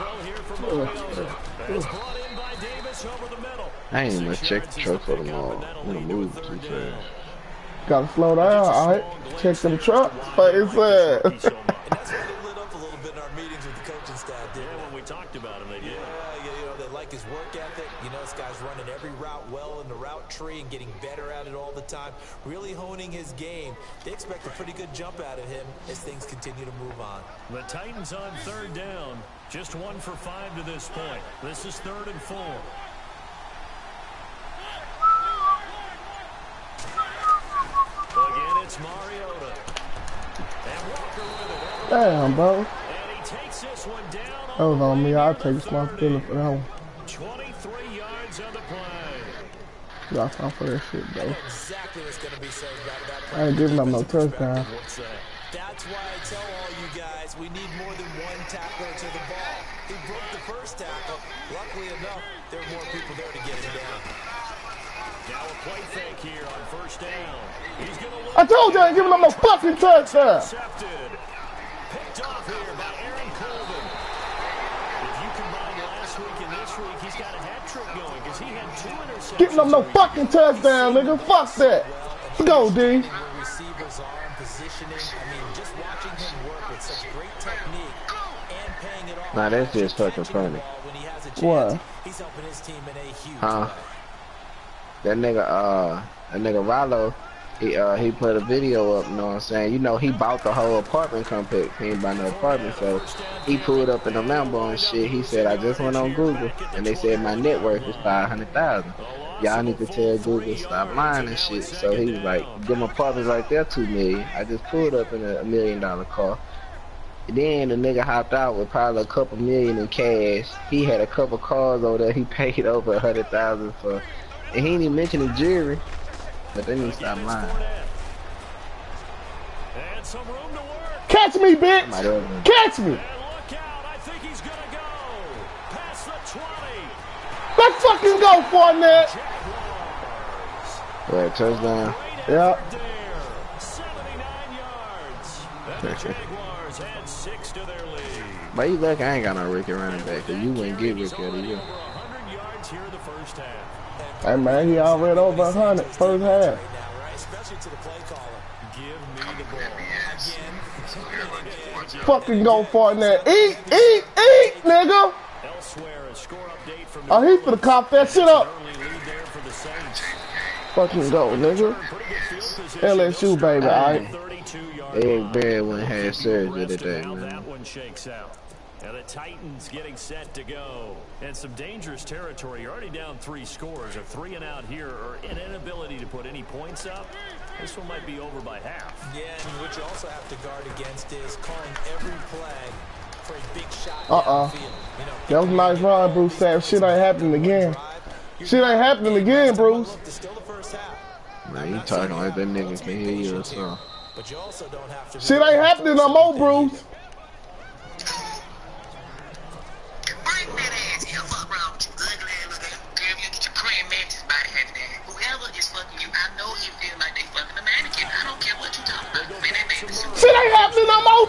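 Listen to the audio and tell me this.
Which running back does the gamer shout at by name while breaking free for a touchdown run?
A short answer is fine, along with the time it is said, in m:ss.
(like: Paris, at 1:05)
Fournette, at 2:18.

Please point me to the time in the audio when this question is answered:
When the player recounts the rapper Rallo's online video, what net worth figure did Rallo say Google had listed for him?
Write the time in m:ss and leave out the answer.
1:47.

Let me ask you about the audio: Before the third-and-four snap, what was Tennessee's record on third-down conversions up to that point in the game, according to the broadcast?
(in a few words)
1 for 5.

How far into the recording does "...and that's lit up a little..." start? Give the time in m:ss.
0:10.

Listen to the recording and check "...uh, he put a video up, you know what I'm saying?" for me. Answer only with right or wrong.
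right.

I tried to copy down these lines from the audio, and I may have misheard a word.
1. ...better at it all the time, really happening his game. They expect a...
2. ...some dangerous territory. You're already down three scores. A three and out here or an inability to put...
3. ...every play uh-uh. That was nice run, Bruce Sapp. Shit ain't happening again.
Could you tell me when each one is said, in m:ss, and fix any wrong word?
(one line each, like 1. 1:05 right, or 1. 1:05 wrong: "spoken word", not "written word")
1. 0:21 wrong: "honing", not "happening"
2. 3:01 right
3. 3:11 right.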